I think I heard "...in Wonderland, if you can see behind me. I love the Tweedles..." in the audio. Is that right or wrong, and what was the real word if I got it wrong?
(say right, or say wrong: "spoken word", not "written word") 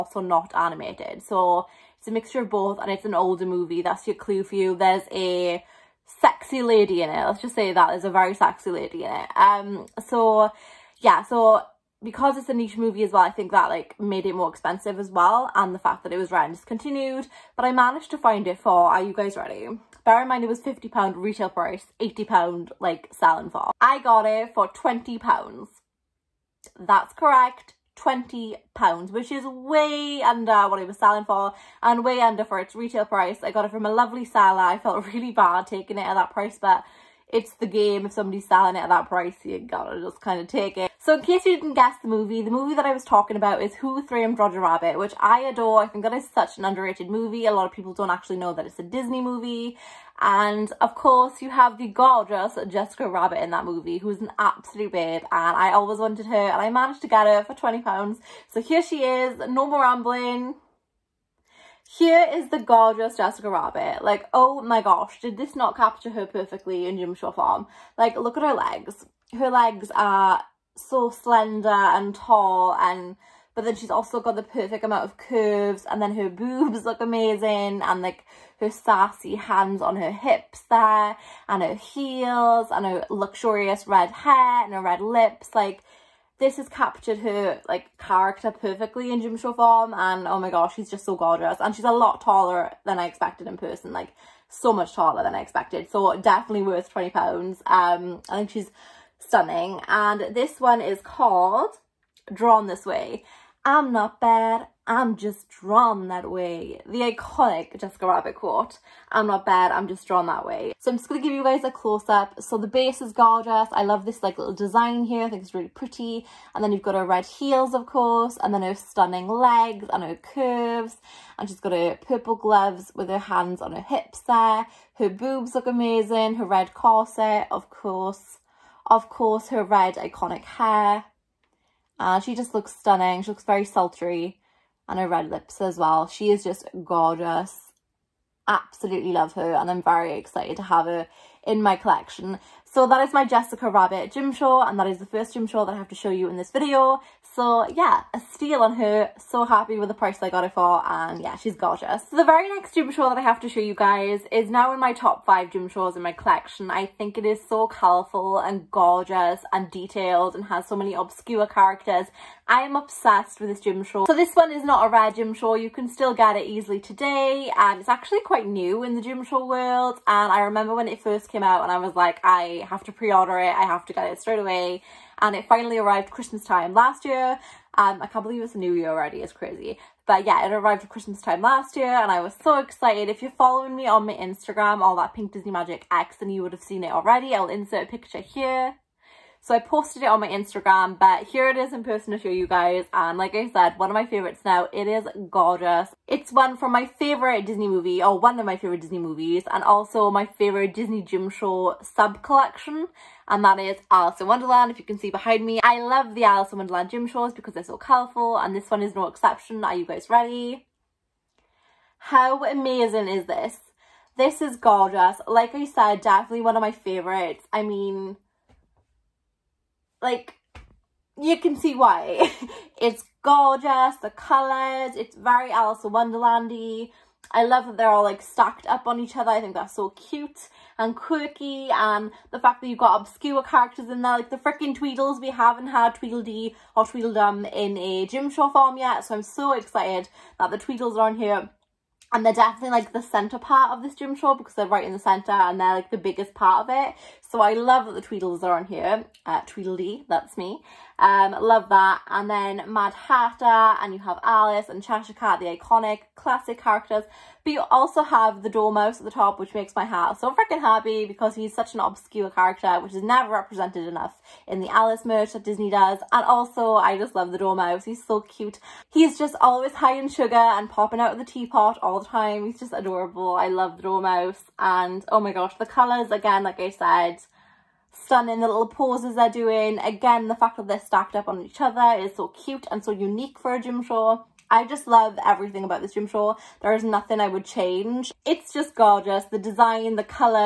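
wrong: "Alice", not "Tweedles".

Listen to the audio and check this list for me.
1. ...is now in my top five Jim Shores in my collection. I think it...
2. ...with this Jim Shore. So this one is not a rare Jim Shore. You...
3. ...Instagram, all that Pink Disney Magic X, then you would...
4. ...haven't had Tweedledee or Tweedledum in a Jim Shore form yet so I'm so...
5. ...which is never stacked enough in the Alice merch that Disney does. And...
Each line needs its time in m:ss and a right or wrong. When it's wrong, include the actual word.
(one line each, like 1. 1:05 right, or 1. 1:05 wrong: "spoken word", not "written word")
1. 2:34 right
2. 2:43 right
3. 3:04 right
4. 3:55 right
5. 4:22 wrong: "represented", not "stacked".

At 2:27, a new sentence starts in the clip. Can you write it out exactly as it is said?
So yeah, a steal on her.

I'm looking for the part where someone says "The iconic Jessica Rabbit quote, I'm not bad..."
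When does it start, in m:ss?
1:46.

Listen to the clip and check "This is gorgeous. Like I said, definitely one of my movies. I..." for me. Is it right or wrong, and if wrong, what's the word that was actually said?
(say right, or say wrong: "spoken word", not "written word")
wrong: "favourites", not "movies".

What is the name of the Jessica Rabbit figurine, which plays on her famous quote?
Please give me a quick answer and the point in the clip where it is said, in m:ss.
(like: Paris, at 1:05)
Drawn This Way, at 1:42.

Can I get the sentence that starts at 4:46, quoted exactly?
There is nothing I would change.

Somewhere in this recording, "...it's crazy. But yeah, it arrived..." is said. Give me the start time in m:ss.
2:59.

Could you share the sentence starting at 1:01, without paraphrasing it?
Here is the gorgeous Jessica Rabbit.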